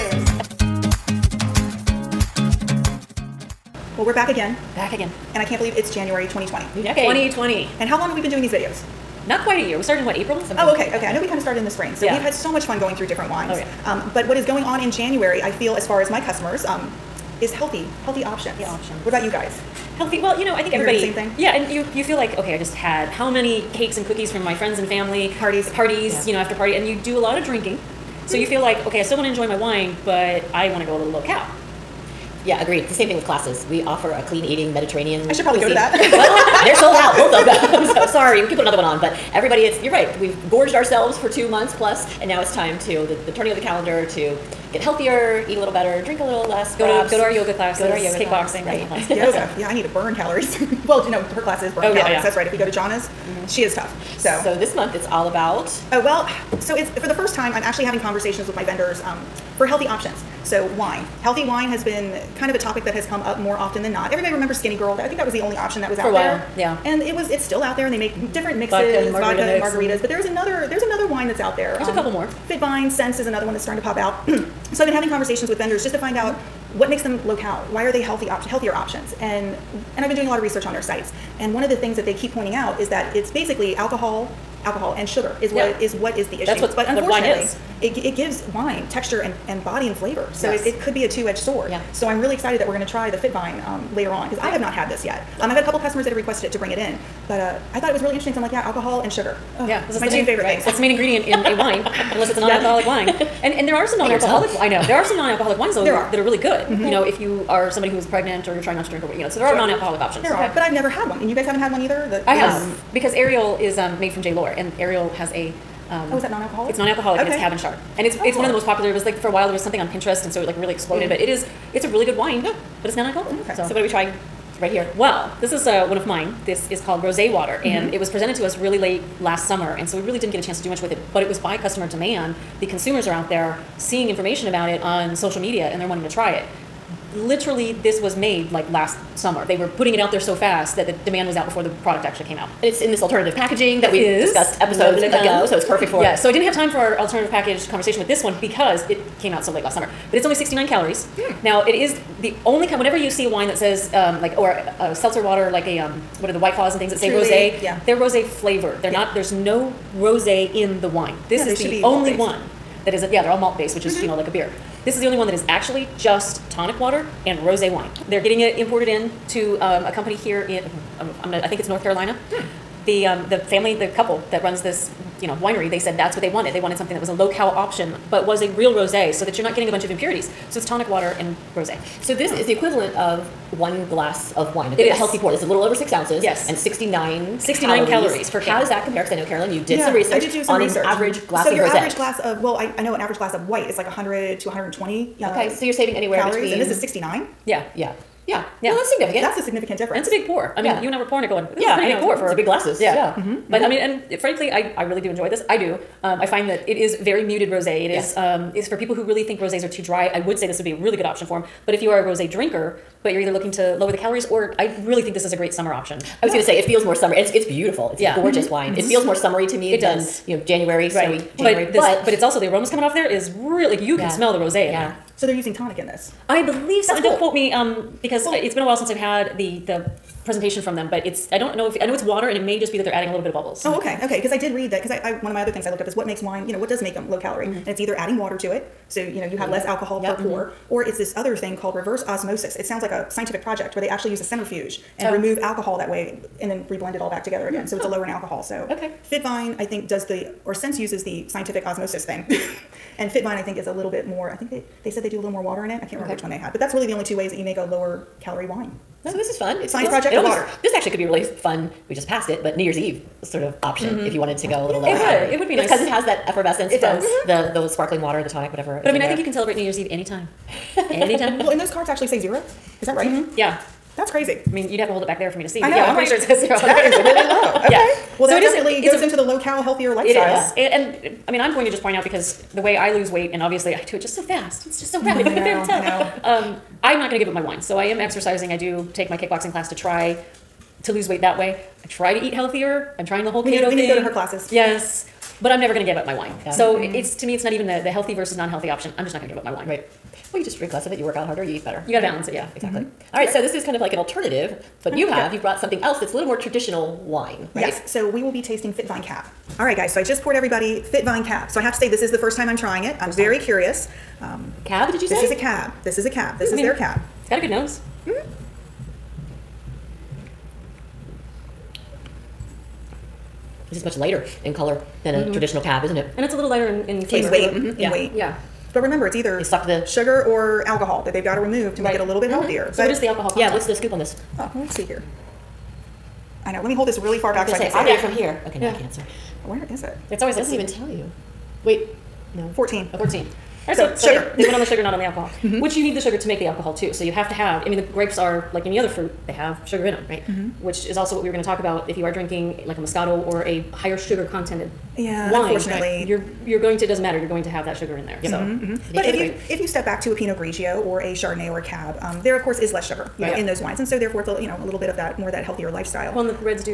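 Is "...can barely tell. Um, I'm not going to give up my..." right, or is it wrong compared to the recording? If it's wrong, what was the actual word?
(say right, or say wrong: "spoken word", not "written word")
right.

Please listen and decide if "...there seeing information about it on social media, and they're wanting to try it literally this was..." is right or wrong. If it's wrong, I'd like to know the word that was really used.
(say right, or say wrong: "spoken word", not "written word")
right.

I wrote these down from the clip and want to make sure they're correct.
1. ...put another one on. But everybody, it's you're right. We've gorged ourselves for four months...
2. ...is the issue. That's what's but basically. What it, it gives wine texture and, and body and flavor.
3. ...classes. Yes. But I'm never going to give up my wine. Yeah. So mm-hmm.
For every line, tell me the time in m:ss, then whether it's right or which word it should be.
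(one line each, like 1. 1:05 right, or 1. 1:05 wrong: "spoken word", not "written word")
1. 0:38 wrong: "two", not "four"
2. 1:26 wrong: "unfortunately", not "basically"
3. 4:54 right.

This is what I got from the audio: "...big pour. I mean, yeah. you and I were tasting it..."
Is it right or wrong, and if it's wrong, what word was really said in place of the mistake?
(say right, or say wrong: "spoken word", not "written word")
wrong: "pouring", not "tasting".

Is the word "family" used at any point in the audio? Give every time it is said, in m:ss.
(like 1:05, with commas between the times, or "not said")
0:24, 2:53.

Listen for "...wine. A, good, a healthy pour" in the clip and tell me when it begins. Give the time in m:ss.
3:04.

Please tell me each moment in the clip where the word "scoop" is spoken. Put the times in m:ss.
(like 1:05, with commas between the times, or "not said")
5:33.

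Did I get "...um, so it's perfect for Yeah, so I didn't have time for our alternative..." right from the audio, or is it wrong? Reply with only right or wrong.
right.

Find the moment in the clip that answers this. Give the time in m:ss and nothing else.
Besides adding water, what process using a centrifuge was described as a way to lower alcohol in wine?
4:01.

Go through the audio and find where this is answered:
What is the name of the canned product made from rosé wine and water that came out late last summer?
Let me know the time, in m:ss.
2:07.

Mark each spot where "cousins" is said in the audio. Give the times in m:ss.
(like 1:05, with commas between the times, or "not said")
not said.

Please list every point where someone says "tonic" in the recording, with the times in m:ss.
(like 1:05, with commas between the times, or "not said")
2:46, 3:00, 3:45, 4:28.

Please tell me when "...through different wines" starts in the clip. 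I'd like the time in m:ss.
0:12.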